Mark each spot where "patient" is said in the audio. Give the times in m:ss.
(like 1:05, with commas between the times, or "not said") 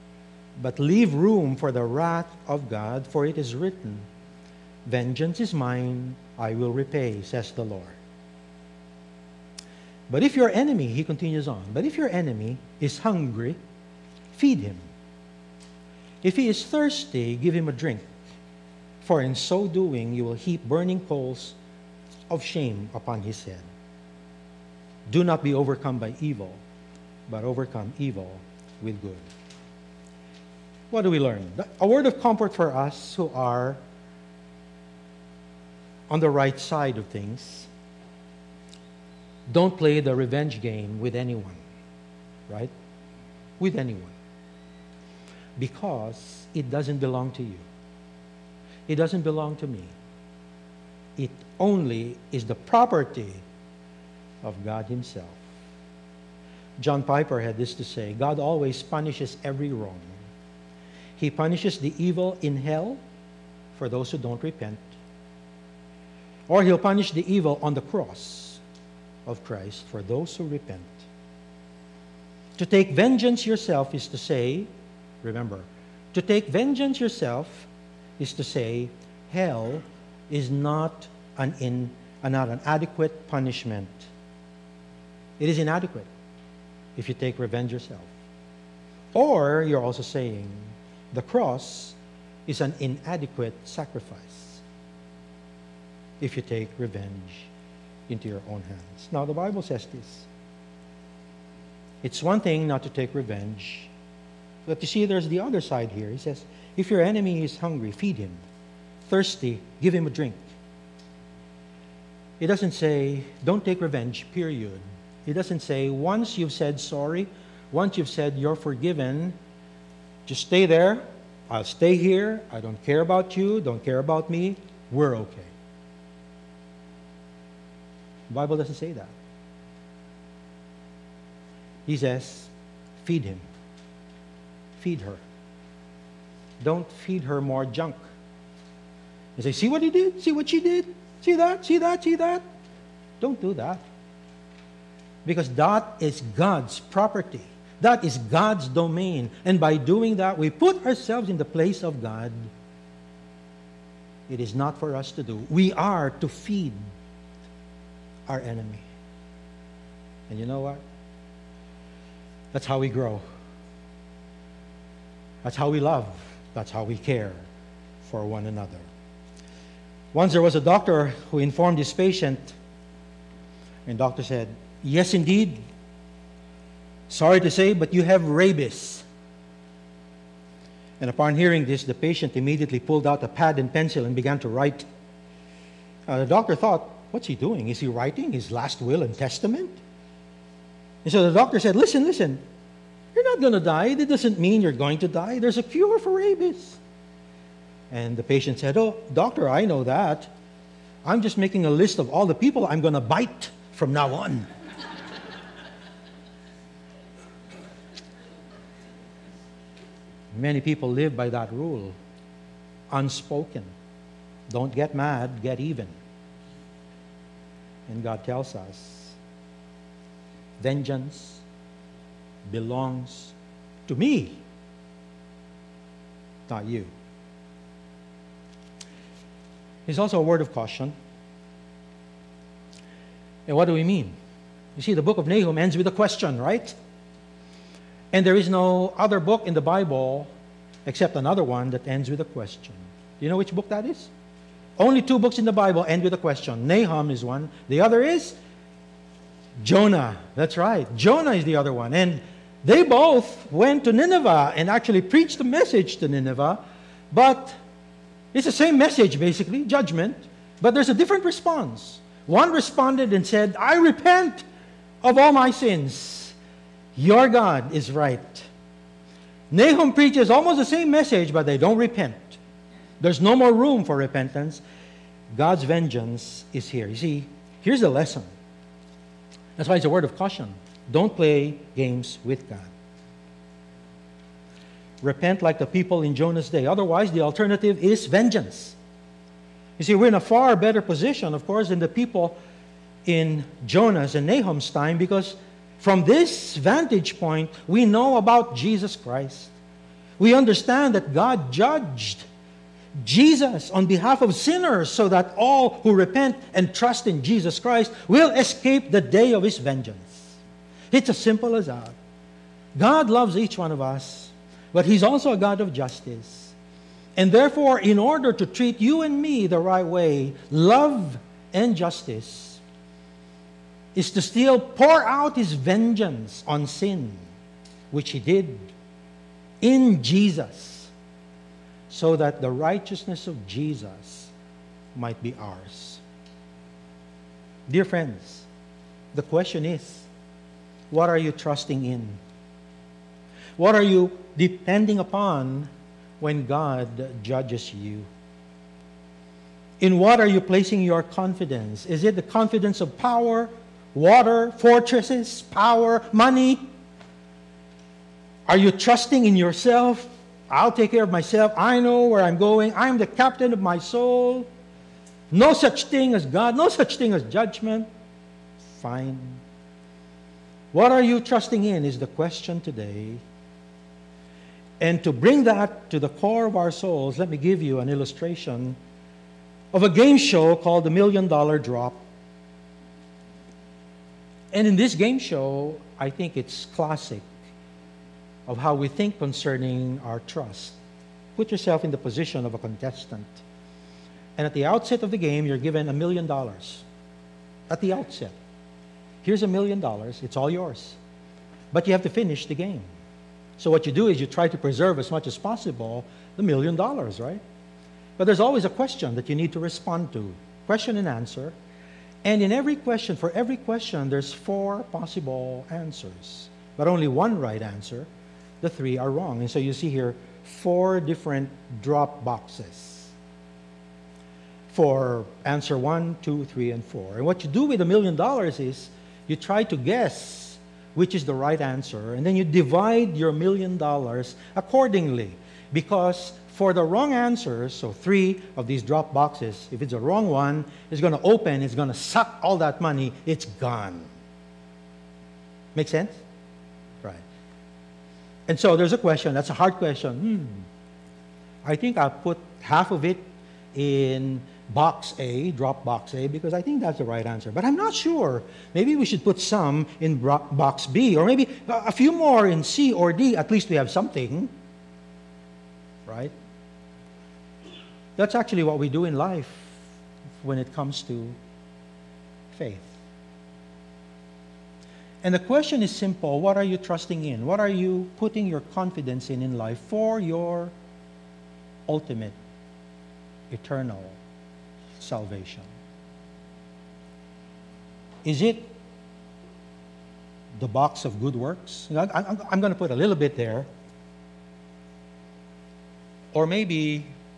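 2:51, 3:01, 3:18.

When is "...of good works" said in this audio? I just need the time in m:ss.
8:11.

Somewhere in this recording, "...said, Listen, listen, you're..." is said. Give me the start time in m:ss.
3:11.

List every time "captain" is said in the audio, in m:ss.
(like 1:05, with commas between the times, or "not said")
6:03.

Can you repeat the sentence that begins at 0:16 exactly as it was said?
If he is thirsty, give him a drink.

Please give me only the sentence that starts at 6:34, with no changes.
And at the outset of the game, you're given a million dollars.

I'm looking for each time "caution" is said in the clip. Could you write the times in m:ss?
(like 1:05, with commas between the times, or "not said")
3:50, 4:40.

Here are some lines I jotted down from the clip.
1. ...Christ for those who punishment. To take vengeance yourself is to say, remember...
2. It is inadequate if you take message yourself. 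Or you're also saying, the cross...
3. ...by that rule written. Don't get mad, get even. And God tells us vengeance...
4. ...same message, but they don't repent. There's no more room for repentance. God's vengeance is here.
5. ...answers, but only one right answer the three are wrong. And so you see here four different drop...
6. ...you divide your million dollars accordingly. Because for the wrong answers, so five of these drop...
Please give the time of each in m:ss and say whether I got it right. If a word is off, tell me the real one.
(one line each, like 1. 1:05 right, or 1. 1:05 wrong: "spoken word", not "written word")
1. 1:09 wrong: "repent", not "punishment"
2. 1:25 wrong: "revenge", not "message"
3. 3:31 wrong: "unspoken", not "written"
4. 4:30 right
5. 6:55 right
6. 7:12 wrong: "three", not "five".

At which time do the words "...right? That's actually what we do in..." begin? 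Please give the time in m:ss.
7:46.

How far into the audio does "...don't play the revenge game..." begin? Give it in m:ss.
0:39.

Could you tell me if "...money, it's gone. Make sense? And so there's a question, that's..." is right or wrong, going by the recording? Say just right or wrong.
right.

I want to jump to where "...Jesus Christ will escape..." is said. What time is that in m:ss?
5:07.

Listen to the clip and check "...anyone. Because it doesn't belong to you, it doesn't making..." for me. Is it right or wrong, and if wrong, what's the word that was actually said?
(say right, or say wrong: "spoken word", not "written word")
wrong: "belong", not "making".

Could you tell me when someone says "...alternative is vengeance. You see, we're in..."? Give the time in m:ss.
4:47.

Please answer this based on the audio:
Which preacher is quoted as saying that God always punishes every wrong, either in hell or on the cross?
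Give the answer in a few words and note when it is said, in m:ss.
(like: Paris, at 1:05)
John Piper, at 0:56.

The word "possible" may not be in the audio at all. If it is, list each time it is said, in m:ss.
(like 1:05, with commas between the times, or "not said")
6:45, 6:54.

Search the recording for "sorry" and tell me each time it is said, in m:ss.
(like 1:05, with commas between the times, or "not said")
1:56, 2:57.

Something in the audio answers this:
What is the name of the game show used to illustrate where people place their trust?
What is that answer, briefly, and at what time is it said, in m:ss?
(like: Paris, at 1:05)
The Million Dollar Drop, at 6:20.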